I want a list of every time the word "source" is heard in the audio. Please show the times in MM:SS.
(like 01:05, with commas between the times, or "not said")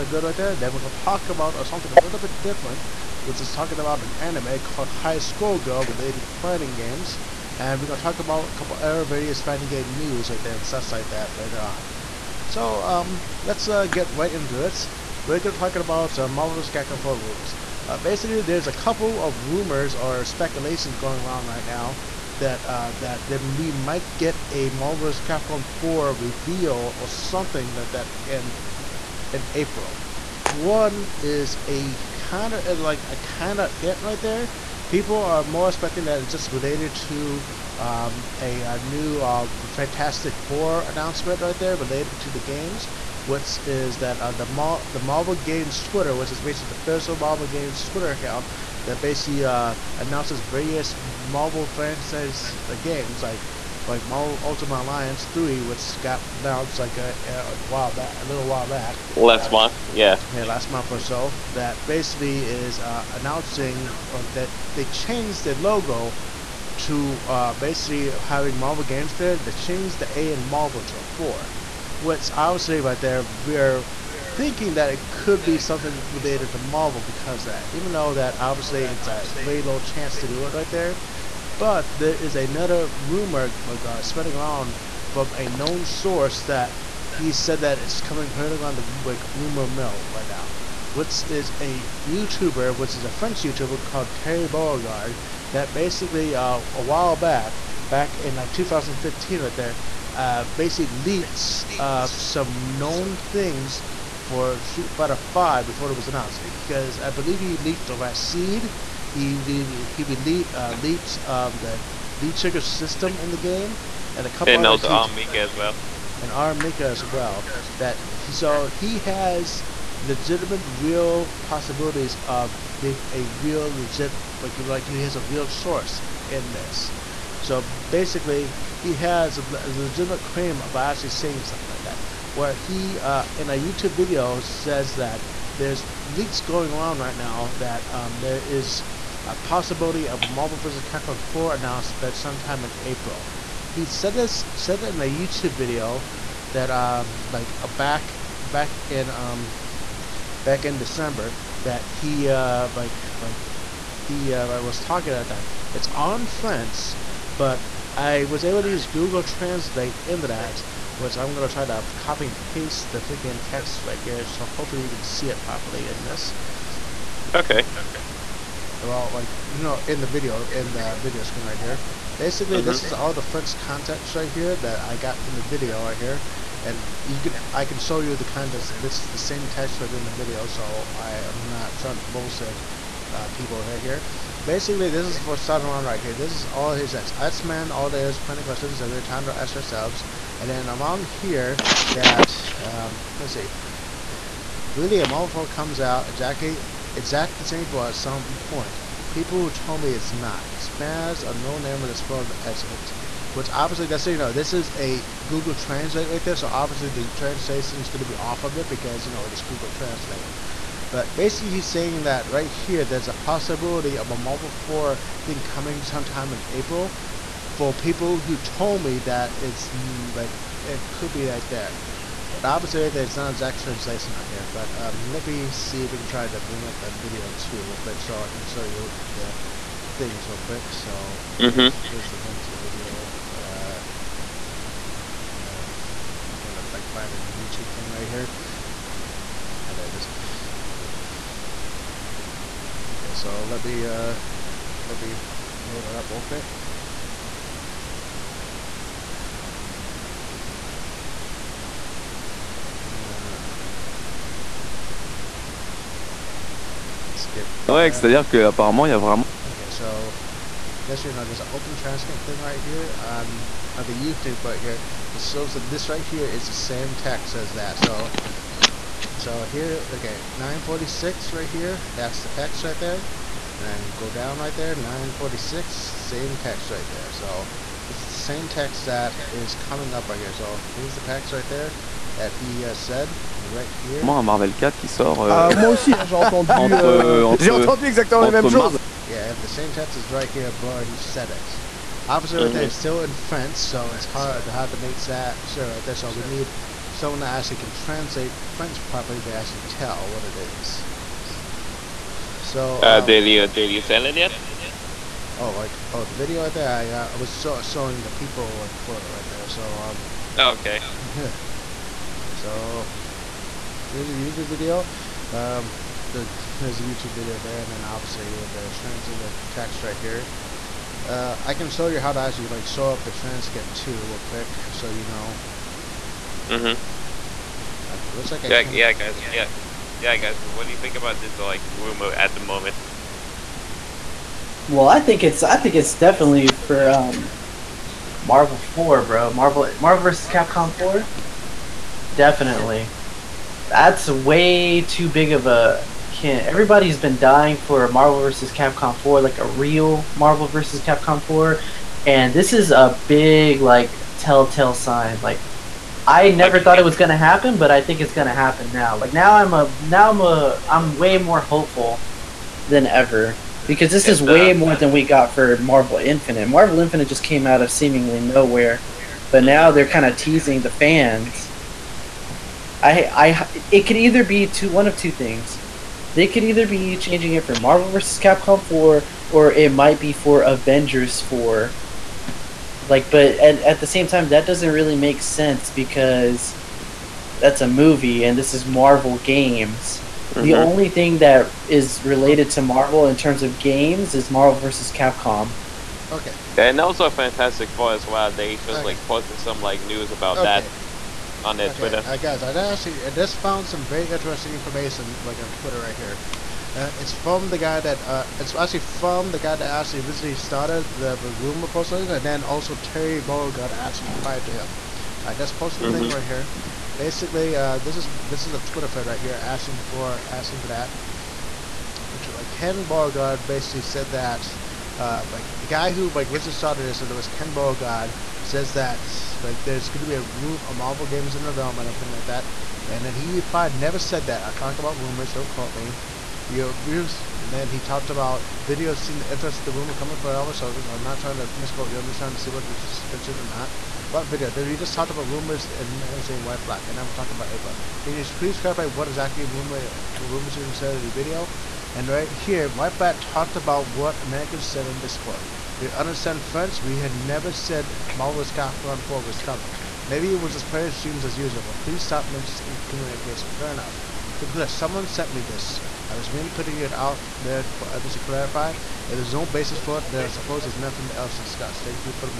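01:25, 02:05.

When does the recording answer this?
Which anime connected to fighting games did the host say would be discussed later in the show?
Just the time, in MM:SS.
00:04.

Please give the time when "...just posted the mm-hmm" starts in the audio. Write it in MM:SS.
06:55.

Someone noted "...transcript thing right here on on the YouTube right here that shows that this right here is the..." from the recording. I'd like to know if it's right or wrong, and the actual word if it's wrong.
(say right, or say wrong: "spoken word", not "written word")
right.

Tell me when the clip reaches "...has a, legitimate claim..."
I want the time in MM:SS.
02:08.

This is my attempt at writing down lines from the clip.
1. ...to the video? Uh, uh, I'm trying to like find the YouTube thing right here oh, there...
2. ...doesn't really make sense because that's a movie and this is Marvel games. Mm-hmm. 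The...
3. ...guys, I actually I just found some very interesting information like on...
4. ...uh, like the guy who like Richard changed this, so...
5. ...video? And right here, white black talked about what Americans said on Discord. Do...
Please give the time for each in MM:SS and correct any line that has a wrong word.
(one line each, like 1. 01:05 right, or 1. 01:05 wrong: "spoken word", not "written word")
1. 03:52 right
2. 06:24 right
3. 06:42 right
4. 07:04 wrong: "started", not "changed"
5. 07:31 right.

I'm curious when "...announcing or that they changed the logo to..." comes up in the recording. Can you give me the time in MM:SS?
01:03.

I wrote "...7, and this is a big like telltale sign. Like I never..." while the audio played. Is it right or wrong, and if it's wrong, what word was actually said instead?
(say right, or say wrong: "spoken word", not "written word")
wrong: "4", not "7".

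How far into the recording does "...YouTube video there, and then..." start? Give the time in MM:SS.
05:16.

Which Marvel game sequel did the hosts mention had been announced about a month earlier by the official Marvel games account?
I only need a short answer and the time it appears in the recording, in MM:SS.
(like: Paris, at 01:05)
Marvel Ultimate Alliance 3, at 00:54.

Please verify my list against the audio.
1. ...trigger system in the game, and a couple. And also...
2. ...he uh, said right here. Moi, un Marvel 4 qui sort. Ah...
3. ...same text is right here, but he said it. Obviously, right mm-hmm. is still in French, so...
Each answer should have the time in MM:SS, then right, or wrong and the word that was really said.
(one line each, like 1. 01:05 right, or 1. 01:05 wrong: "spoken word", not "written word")
1. 01:52 right
2. 04:42 right
3. 04:49 right.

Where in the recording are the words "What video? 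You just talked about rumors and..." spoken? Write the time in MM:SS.
07:24.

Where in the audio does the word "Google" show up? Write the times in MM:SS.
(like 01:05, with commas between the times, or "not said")
02:38, 03:25, 03:29.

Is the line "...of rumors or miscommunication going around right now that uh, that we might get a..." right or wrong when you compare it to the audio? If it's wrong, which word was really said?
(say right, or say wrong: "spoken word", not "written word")
wrong: "speculation", not "miscommunication".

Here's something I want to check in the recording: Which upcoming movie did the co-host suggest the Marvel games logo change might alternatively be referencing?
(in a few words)
Avengers 4.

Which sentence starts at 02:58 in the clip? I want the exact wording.
This is the same text right in the video, so I am not trying to bullshit uh, people here.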